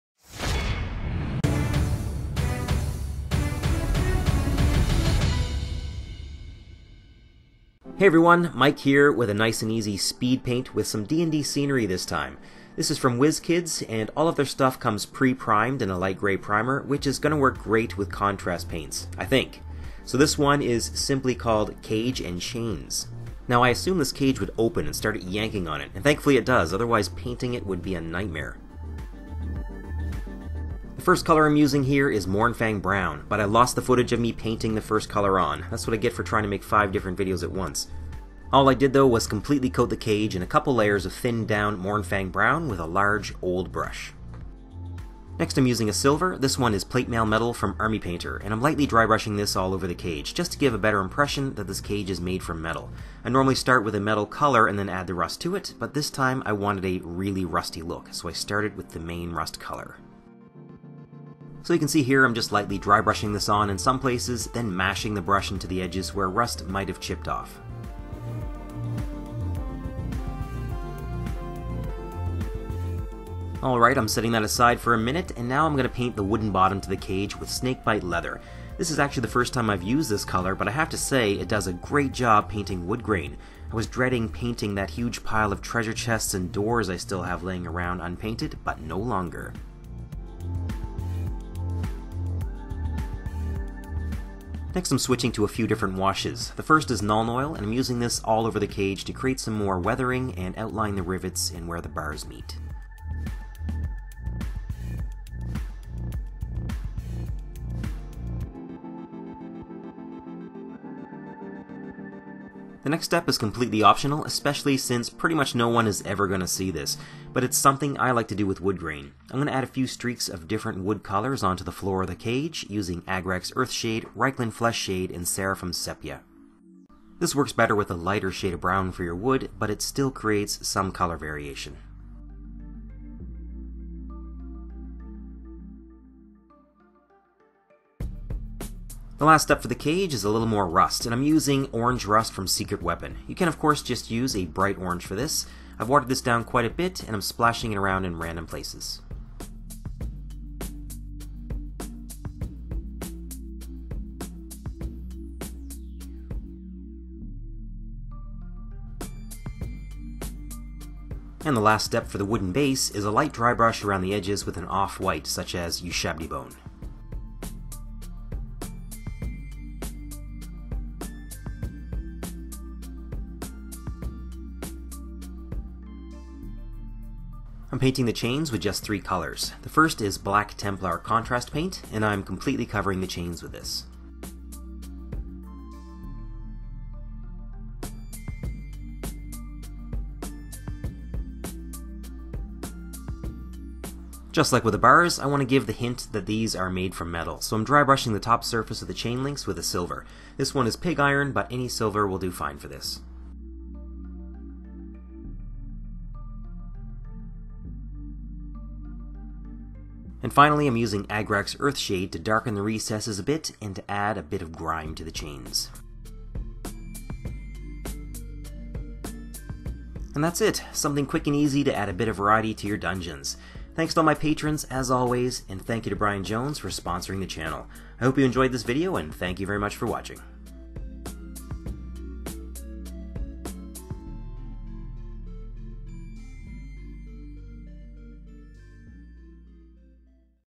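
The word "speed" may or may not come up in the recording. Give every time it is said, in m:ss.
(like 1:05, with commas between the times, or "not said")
0:09.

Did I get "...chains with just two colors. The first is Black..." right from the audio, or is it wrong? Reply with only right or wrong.
wrong.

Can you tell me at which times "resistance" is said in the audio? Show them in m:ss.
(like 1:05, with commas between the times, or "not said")
not said.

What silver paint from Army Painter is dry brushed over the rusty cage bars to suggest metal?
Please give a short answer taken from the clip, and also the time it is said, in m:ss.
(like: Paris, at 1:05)
Plate Mail Metal, at 0:46.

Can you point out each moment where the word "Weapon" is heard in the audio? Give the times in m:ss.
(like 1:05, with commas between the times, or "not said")
2:22.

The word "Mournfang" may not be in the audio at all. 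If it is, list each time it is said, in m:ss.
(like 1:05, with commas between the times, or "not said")
0:32, 0:41.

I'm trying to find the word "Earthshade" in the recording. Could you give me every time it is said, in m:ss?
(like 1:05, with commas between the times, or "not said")
2:03, 3:31.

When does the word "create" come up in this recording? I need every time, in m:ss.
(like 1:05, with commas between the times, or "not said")
1:39, 2:10.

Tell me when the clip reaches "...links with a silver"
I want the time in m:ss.
3:19.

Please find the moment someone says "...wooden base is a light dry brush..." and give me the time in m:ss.
2:42.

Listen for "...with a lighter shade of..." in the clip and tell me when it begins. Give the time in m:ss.
2:07.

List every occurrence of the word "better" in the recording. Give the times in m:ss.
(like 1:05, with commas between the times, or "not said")
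0:50, 2:07.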